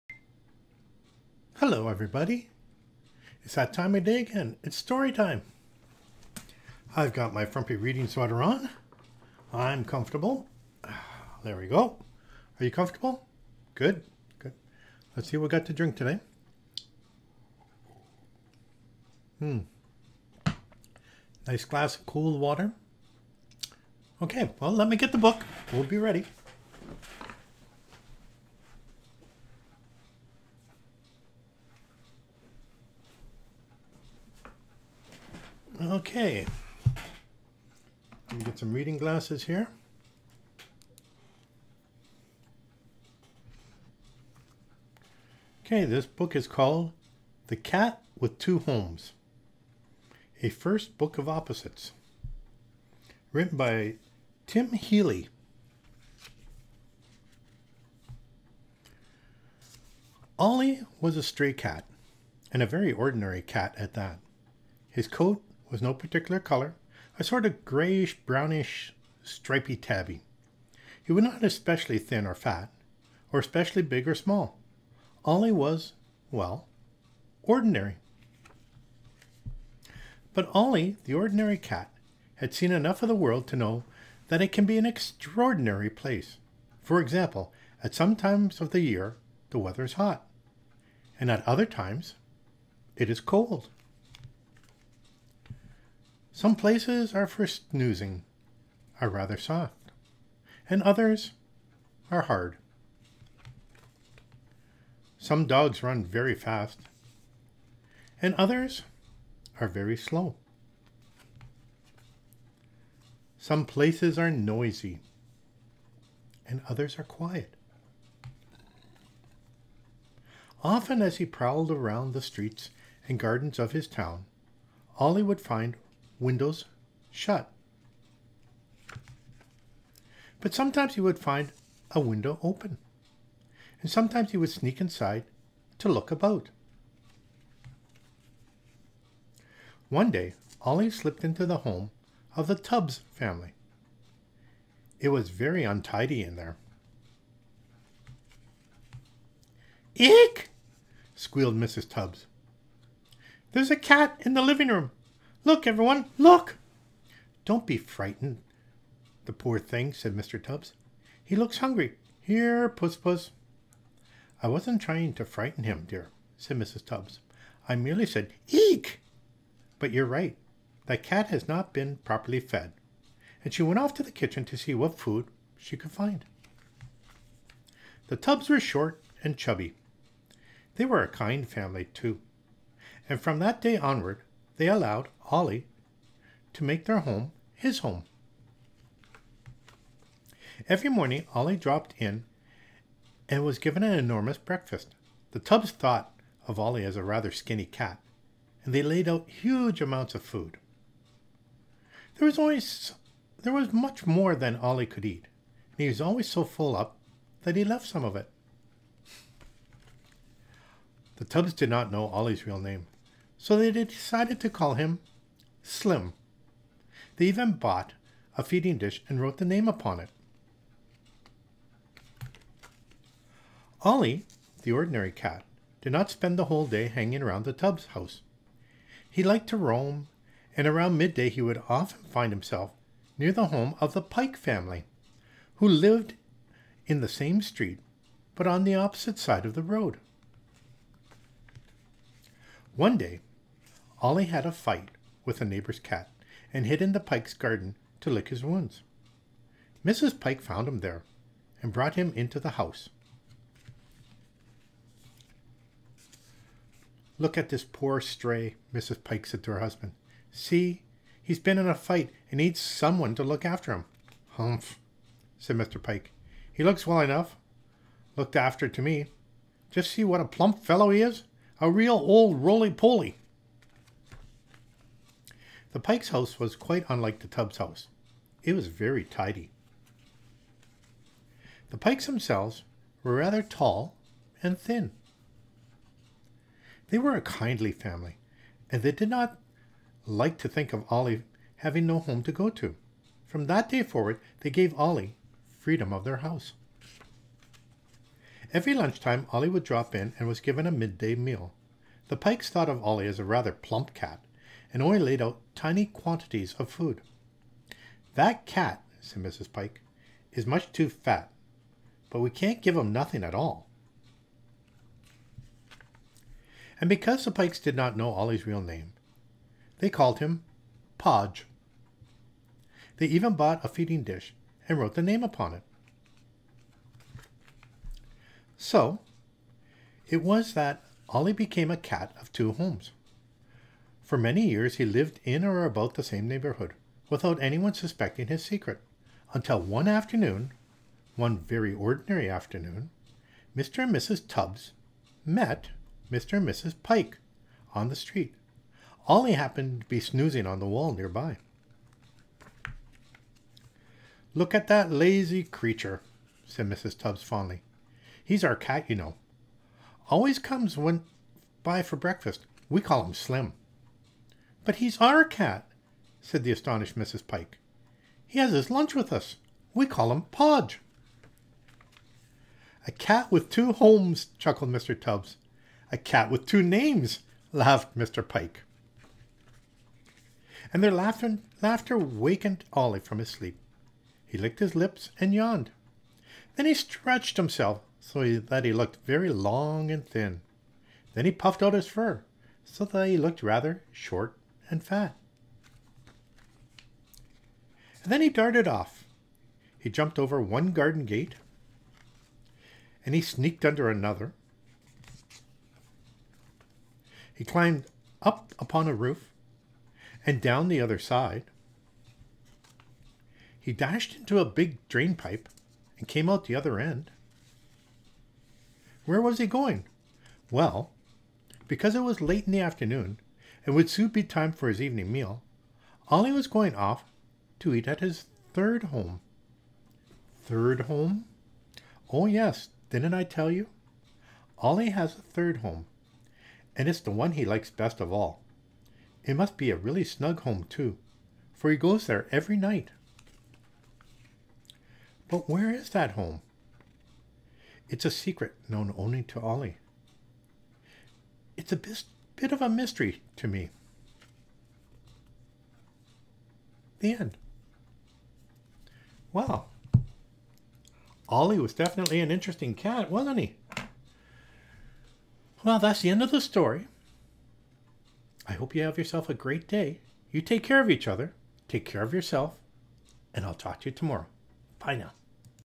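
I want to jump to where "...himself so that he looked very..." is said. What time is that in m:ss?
6:27.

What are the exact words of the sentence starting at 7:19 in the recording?
It must be a really snug home, too, for he goes there every night.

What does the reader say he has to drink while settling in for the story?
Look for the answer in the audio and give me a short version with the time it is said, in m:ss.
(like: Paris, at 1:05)
cool water, at 0:22.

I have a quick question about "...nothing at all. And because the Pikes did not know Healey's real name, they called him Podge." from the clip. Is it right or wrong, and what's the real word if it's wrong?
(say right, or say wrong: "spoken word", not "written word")
wrong: "Ollie", not "Healey".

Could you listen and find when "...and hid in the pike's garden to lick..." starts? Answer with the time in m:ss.
4:06.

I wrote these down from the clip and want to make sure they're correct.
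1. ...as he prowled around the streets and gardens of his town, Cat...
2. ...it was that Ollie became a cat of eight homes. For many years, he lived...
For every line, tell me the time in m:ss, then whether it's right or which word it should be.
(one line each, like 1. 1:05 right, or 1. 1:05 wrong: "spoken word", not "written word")
1. 2:01 wrong: "Ollie", not "Cat"
2. 5:30 wrong: "two", not "eight".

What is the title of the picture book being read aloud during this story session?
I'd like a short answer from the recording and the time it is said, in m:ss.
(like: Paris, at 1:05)
The Cat with Two Homes, at 0:47.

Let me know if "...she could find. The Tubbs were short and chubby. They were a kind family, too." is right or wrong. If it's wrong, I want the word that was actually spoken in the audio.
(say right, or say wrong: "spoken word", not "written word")
right.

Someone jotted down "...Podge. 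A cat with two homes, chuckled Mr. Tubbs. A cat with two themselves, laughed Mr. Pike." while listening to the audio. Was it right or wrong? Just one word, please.
wrong.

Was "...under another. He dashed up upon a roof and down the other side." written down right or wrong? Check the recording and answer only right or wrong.
wrong.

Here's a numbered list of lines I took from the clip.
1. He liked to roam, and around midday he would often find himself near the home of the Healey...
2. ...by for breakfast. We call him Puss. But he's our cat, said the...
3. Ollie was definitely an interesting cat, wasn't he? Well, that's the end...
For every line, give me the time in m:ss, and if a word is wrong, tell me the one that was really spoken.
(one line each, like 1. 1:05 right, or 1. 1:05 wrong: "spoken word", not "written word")
1. 3:49 wrong: "Pike", not "Healey"
2. 6:01 wrong: "Slim", not "Puss"
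3. 7:41 right.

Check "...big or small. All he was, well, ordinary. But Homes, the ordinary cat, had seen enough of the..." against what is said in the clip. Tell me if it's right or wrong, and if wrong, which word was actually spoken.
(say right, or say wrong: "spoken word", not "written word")
wrong: "Ollie", not "Homes".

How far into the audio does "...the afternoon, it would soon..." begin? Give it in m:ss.
7:02.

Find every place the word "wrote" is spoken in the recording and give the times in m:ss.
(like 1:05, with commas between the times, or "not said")
3:39, 5:24.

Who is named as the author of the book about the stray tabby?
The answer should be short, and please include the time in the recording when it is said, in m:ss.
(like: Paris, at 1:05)
Tim Healey, at 0:54.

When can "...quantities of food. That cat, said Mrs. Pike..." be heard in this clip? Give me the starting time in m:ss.
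5:05.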